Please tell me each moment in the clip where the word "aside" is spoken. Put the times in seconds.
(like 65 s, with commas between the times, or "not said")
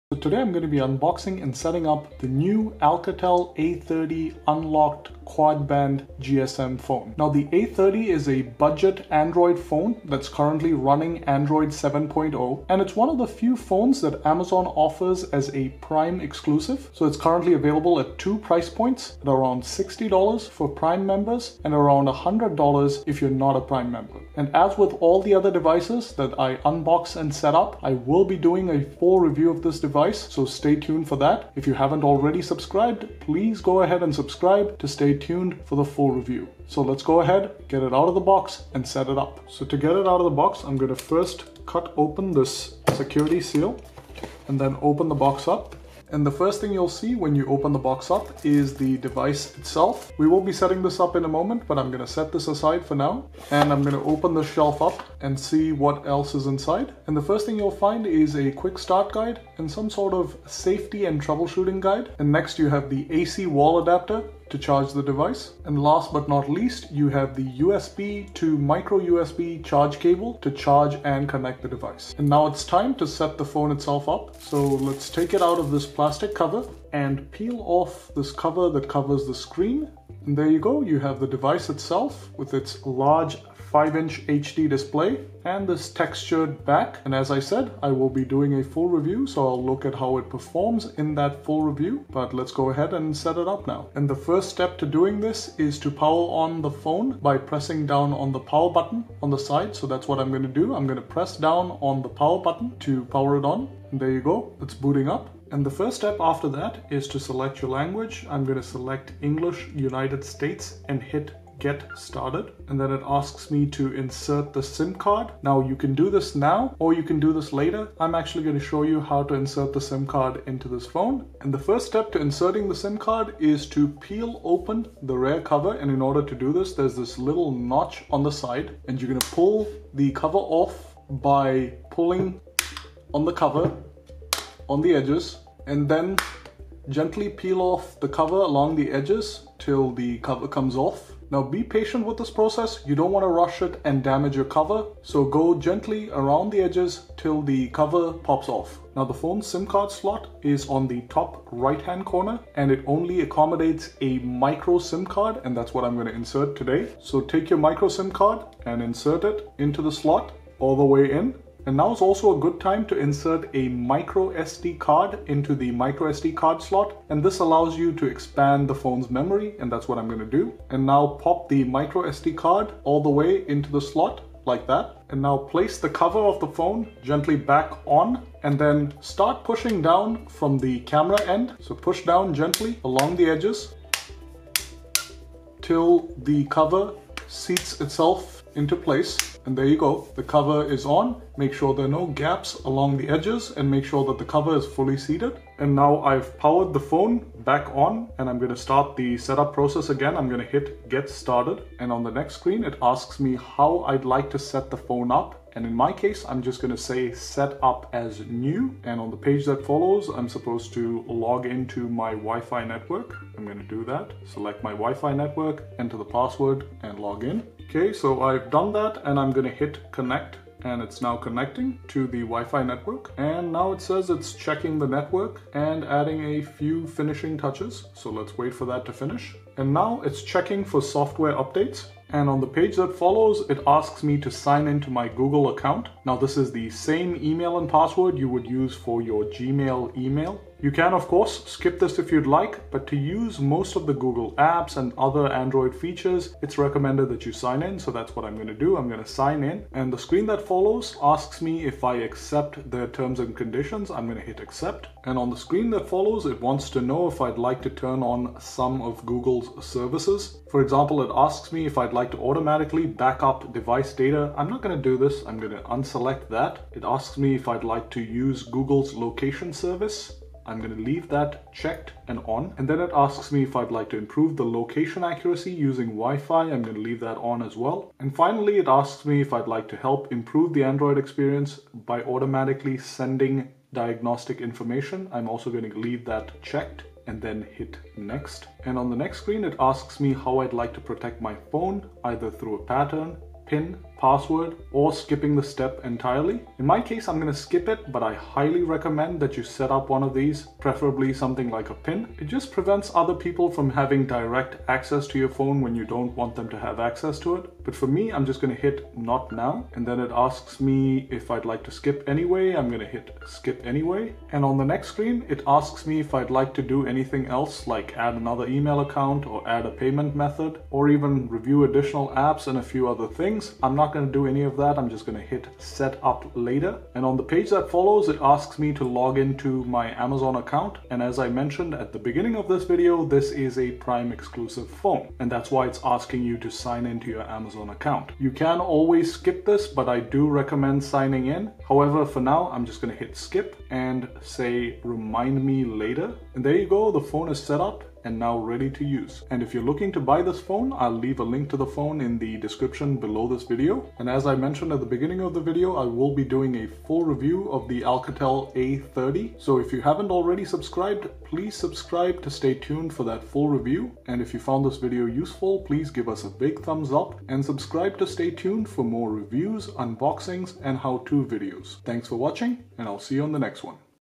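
52 s.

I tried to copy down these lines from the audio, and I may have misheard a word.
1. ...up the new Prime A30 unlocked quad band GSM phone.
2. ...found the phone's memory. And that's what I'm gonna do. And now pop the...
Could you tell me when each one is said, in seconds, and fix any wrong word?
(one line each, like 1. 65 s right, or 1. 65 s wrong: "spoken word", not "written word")
1. 1 s wrong: "Alcatel", not "Prime"
2. 168 s wrong: "expand", not "found".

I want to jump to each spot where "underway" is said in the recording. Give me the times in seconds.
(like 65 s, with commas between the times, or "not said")
not said.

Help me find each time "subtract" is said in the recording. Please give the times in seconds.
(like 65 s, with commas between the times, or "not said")
not said.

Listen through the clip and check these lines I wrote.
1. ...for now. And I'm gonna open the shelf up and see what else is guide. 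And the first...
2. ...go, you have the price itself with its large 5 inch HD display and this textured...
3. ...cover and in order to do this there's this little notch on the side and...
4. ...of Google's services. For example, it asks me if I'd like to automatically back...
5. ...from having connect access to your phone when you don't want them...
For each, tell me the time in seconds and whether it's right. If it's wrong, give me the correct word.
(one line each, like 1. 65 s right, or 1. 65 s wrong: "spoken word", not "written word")
1. 52 s wrong: "inside", not "guide"
2. 80 s wrong: "device", not "price"
3. 125 s right
4. 258 s right
5. 303 s wrong: "direct", not "connect".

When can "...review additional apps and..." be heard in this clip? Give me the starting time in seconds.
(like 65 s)
321 s.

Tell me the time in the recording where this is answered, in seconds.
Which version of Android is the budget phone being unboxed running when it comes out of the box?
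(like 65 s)
11 s.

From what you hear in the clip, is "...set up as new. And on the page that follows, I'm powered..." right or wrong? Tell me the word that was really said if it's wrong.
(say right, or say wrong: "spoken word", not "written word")
wrong: "supposed", not "powered".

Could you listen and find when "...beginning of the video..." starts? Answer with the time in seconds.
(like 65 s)
354 s.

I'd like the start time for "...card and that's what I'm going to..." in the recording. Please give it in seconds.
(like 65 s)
155 s.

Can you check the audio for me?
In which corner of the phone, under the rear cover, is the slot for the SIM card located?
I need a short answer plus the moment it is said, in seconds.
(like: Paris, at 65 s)
Top right, at 151 s.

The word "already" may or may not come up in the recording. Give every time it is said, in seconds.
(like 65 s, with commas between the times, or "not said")
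32 s, 360 s.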